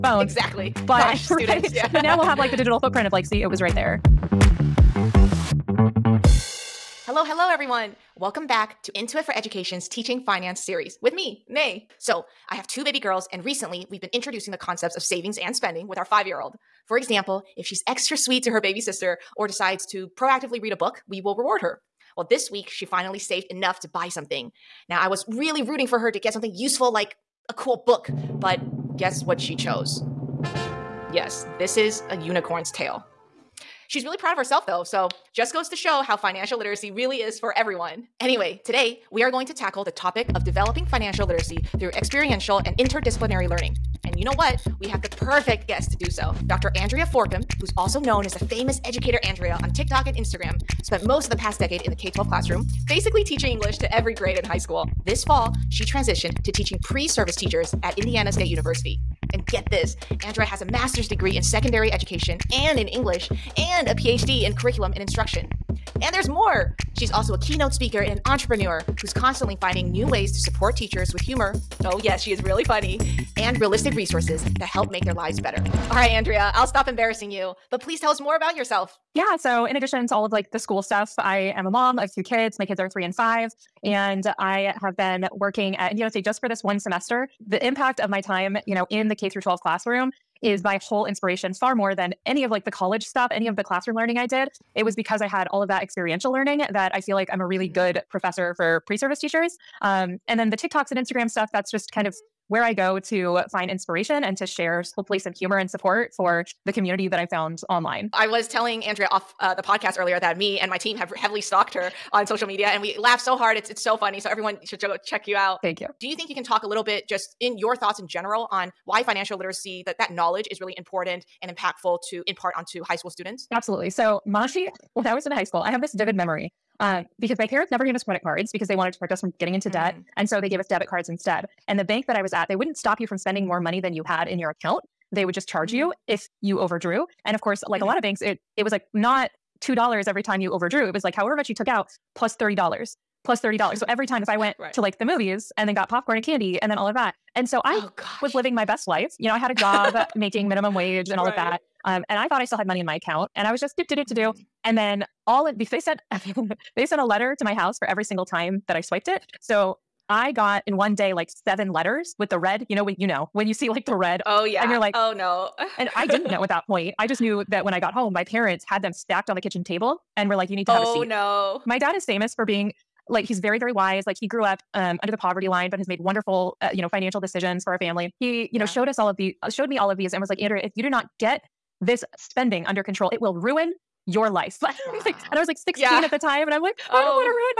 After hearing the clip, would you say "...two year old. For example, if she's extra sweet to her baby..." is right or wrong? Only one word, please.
wrong.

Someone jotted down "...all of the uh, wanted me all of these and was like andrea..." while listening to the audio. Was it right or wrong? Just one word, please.
wrong.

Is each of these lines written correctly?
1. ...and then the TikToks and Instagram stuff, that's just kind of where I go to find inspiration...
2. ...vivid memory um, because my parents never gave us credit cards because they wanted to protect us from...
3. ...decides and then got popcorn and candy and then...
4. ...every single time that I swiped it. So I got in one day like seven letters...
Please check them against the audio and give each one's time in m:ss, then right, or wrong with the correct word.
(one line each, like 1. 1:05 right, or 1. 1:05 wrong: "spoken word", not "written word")
1. 1:40 right
2. 2:05 right
3. 2:25 wrong: "movies", not "decides"
4. 2:37 right.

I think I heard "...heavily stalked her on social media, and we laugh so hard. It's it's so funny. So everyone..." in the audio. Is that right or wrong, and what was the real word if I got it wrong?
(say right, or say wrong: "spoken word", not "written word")
right.